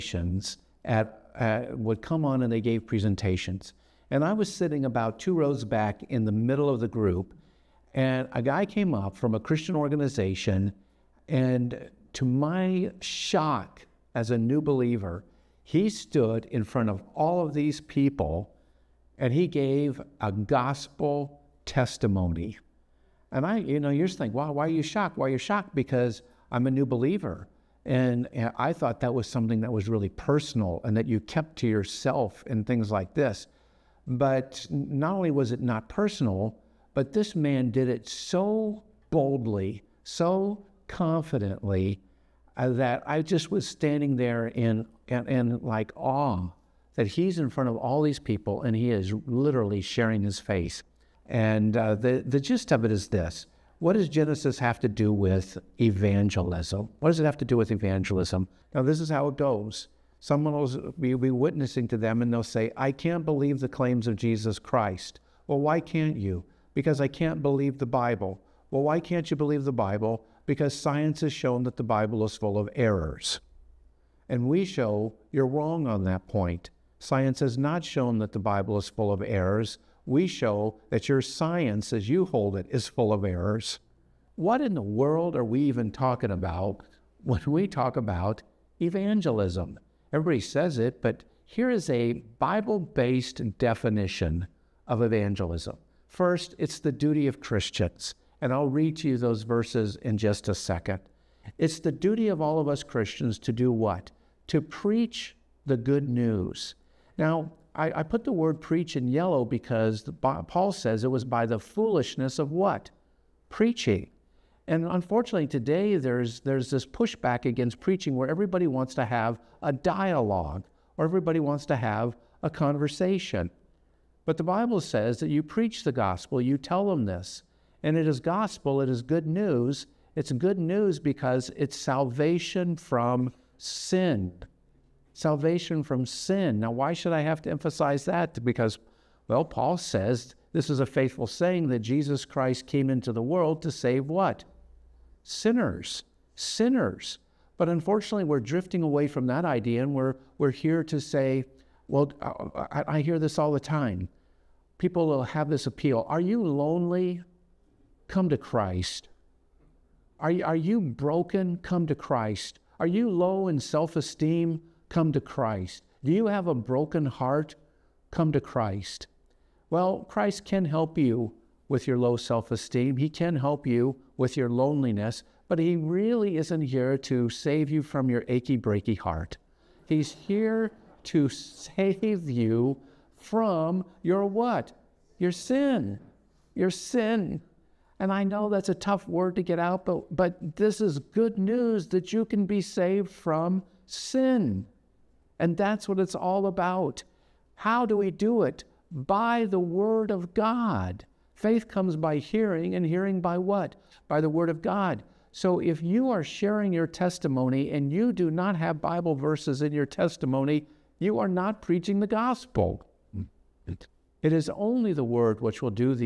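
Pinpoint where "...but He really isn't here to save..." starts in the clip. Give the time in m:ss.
2:55.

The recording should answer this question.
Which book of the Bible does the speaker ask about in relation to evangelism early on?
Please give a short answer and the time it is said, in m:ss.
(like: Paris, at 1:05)
Genesis, at 0:54.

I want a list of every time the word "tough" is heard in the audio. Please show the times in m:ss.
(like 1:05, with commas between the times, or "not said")
3:08.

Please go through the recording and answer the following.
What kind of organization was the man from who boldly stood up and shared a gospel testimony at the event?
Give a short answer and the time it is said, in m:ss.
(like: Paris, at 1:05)
Christian organization, at 0:09.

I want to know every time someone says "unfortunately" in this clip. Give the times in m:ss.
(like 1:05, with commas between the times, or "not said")
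1:54, 2:27.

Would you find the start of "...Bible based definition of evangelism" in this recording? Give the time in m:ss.
1:32.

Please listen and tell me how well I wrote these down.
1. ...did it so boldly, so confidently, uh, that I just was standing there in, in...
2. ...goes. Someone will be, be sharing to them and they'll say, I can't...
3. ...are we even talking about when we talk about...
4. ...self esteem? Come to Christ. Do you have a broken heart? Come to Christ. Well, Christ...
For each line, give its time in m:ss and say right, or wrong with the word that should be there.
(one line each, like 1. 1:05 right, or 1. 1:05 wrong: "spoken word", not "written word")
1. 0:37 right
2. 0:59 wrong: "witnessing", not "sharing"
3. 1:25 right
4. 2:43 right.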